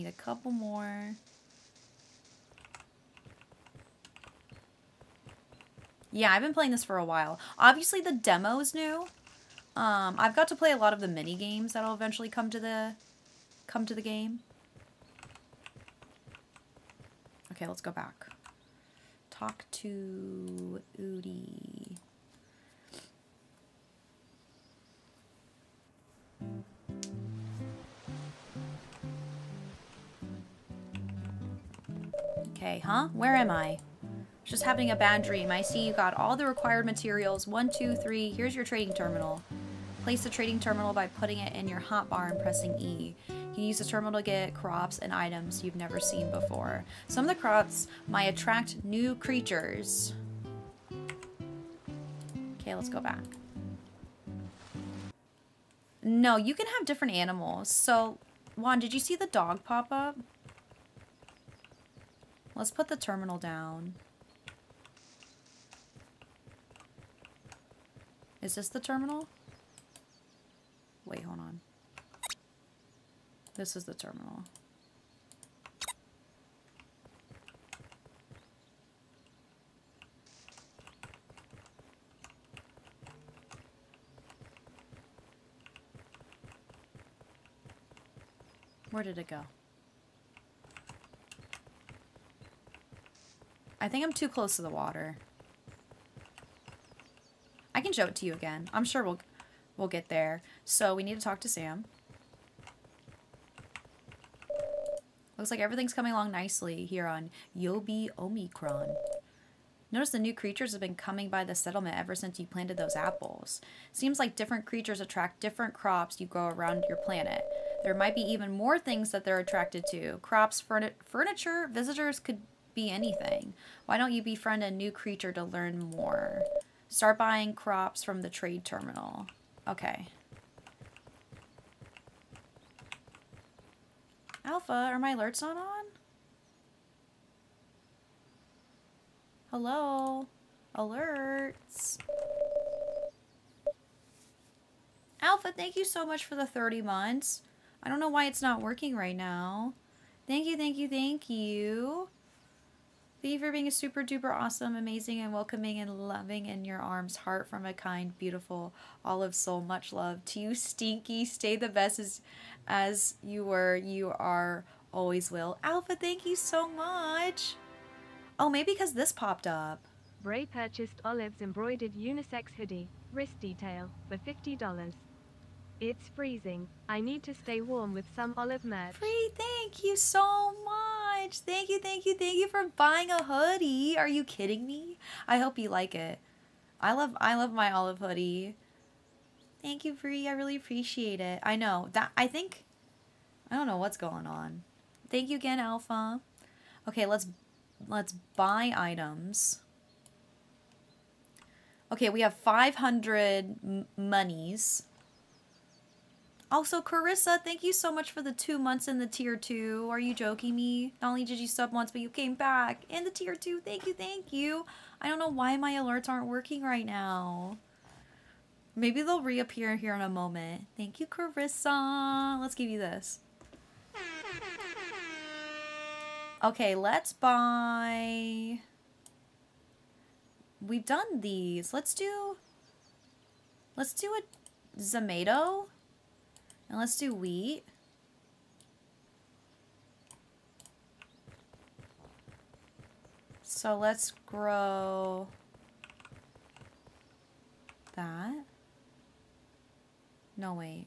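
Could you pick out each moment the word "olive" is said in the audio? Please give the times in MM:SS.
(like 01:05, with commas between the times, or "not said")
02:39, 02:51, 02:58, 03:07.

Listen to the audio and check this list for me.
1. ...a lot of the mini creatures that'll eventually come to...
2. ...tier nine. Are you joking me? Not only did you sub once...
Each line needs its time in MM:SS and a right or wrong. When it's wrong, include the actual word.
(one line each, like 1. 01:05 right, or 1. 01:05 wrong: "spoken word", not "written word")
1. 00:10 wrong: "games", not "creatures"
2. 03:29 wrong: "two", not "nine".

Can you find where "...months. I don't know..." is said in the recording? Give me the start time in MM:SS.
02:26.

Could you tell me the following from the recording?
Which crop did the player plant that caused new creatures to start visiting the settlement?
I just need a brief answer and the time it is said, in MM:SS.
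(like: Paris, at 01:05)
apples, at 01:52.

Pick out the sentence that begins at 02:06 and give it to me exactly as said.
Start buying crops from the trade terminal.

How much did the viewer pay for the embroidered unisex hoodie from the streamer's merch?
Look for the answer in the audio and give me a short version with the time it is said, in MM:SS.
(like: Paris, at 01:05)
$50, at 02:54.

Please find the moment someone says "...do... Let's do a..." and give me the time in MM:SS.
03:51.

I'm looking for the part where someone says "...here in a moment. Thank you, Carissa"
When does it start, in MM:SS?
03:39.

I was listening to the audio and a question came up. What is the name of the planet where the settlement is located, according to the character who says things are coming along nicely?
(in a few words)
Yobi Omicron.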